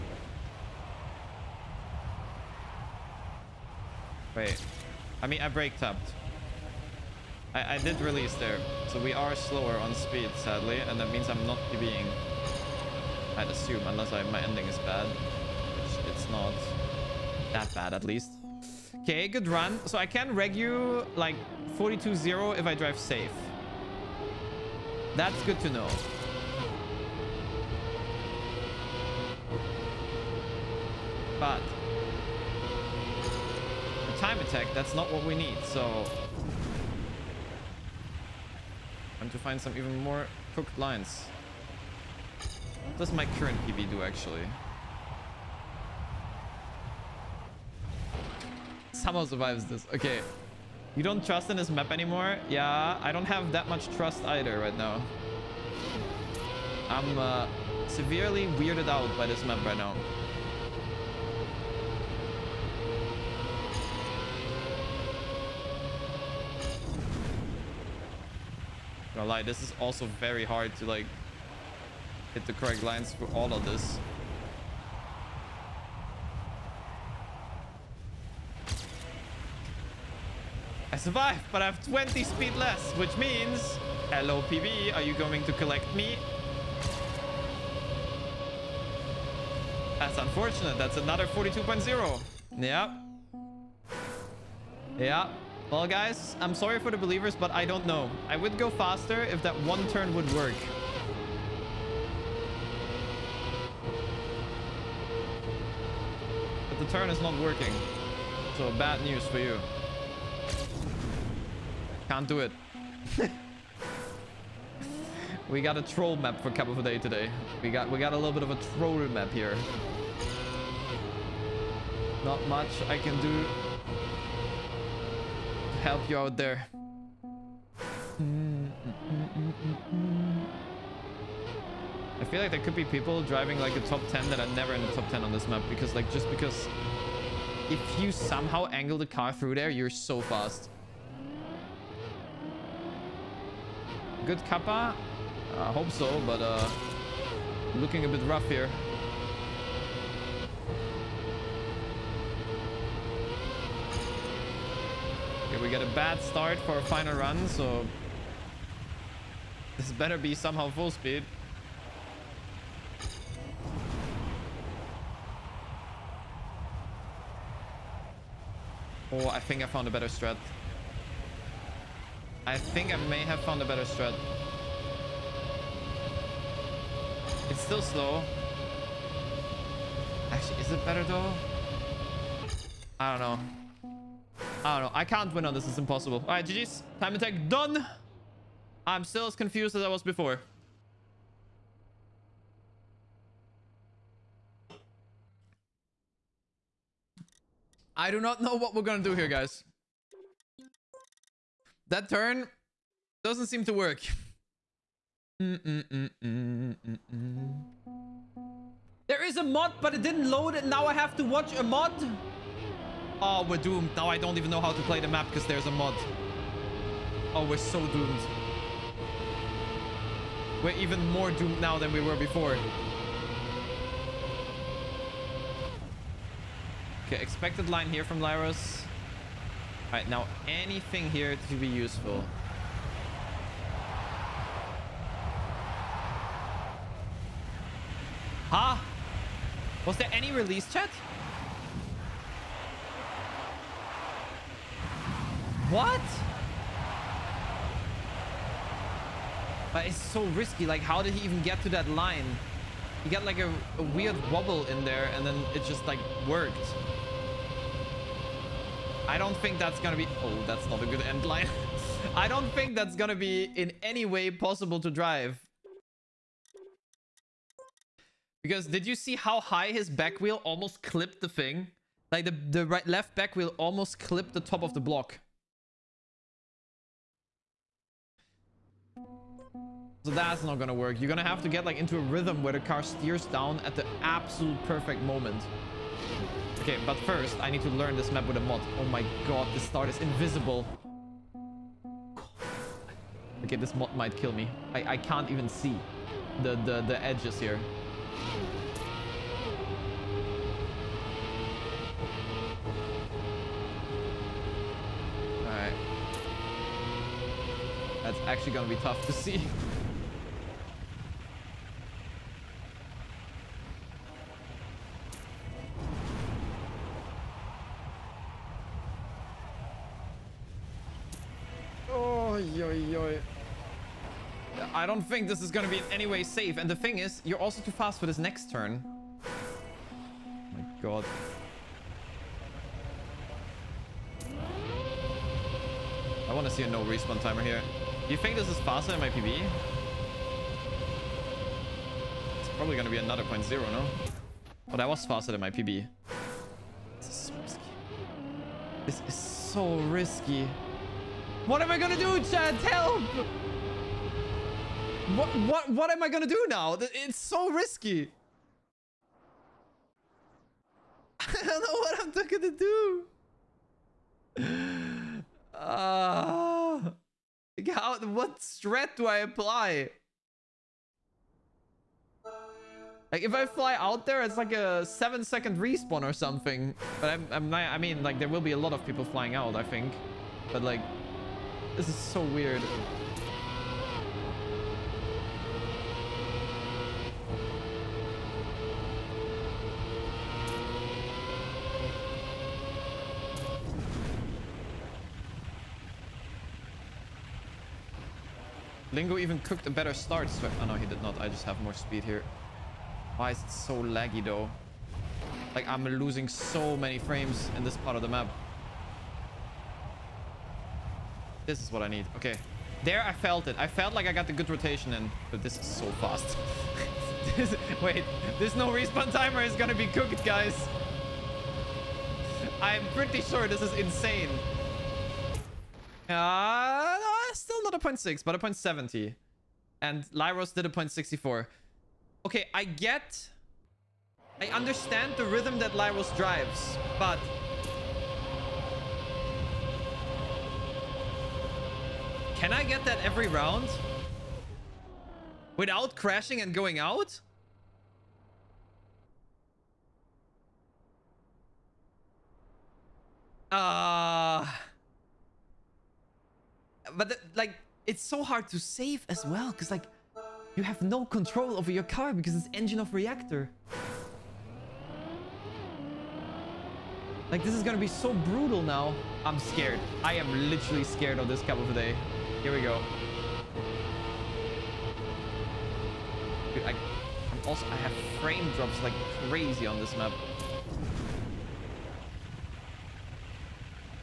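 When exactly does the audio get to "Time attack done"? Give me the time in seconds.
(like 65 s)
186 s.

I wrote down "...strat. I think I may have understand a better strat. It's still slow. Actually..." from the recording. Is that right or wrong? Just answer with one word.
wrong.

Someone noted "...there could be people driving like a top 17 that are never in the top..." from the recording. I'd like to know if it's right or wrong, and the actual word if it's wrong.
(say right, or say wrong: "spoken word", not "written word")
wrong: "10", not "17".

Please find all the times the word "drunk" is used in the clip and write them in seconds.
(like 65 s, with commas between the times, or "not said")
not said.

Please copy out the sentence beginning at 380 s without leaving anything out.
But, like, this is so weird.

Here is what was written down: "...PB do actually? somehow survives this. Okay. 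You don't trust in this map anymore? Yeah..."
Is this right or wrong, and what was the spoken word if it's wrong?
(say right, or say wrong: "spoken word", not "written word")
right.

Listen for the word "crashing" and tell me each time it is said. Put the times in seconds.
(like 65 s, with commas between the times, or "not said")
445 s.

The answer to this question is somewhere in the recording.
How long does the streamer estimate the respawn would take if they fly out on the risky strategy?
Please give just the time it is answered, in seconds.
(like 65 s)
374 s.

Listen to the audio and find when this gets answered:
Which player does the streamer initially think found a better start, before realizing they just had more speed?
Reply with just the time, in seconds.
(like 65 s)
398 s.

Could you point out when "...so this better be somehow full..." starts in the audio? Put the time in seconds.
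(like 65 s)
157 s.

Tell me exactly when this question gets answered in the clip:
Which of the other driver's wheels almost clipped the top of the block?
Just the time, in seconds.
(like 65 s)
272 s.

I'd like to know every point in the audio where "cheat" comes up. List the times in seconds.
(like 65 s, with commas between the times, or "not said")
not said.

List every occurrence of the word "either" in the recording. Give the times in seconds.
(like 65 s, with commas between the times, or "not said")
54 s.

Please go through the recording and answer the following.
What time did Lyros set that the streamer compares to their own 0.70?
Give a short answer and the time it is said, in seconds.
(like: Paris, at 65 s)
0.64, at 430 s.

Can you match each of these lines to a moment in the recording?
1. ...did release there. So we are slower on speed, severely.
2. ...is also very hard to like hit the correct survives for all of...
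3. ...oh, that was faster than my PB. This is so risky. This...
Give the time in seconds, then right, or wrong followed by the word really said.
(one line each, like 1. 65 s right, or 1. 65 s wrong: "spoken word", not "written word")
1. 7 s wrong: "sadly", not "severely"
2. 69 s wrong: "lines", not "survives"
3. 344 s right.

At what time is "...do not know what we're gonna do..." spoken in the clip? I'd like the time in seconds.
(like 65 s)
198 s.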